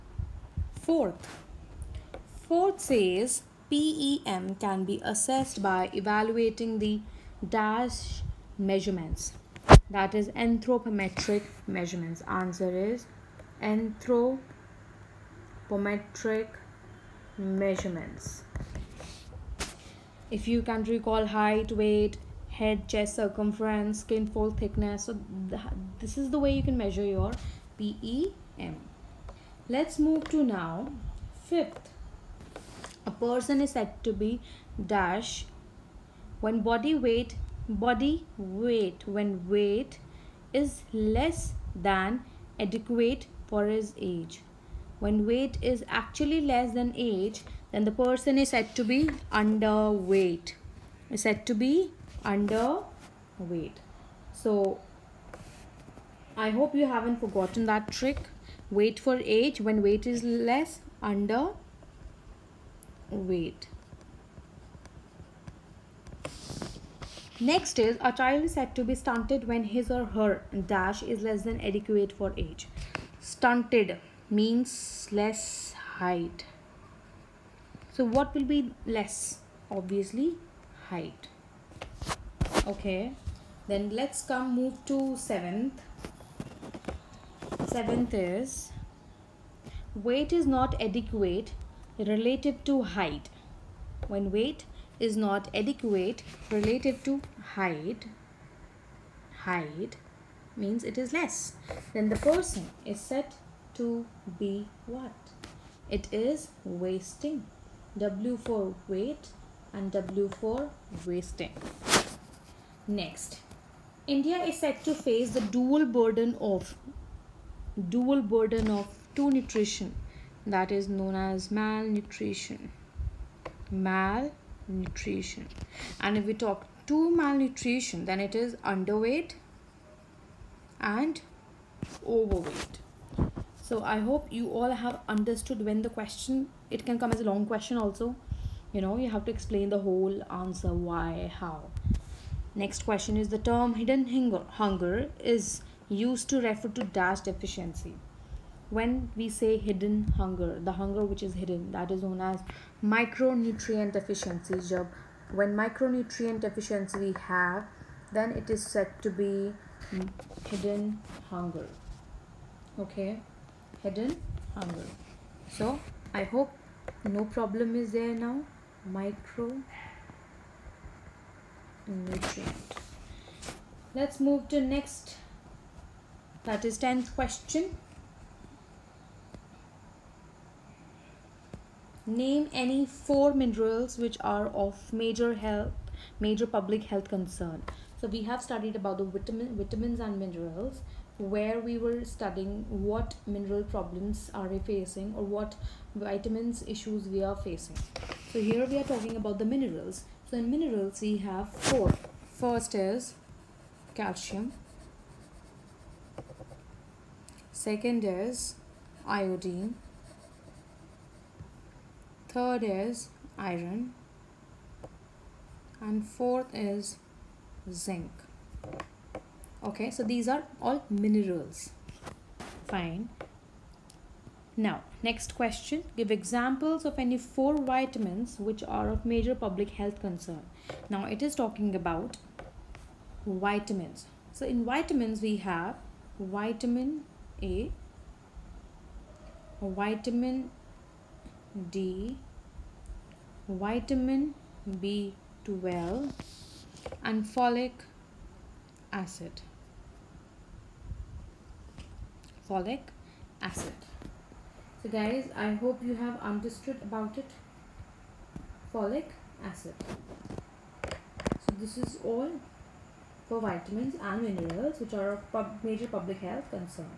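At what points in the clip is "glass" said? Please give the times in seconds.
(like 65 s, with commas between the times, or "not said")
not said.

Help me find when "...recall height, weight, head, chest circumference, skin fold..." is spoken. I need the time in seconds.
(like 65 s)
20 s.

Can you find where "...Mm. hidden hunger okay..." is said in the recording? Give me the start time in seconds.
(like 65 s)
159 s.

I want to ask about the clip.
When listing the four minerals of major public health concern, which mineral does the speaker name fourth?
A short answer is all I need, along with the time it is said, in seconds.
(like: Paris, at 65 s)
Zinc, at 217 s.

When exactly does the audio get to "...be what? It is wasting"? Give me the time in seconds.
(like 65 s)
104 s.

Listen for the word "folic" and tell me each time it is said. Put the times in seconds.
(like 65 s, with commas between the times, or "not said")
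247 s, 252 s, 258 s.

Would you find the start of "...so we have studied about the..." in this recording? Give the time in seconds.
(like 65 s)
188 s.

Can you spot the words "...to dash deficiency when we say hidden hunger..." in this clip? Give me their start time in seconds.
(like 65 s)
146 s.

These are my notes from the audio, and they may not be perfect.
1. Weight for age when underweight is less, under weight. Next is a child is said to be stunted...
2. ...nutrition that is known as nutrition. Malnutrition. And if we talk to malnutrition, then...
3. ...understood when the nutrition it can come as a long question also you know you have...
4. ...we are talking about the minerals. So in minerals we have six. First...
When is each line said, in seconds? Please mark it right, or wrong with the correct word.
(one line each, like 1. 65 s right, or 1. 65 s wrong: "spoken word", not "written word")
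1. 58 s wrong: "weight", not "underweight"
2. 119 s wrong: "malnutrition", not "nutrition"
3. 135 s wrong: "question", not "nutrition"
4. 198 s wrong: "four", not "six".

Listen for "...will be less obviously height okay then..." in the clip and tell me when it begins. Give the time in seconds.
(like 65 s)
78 s.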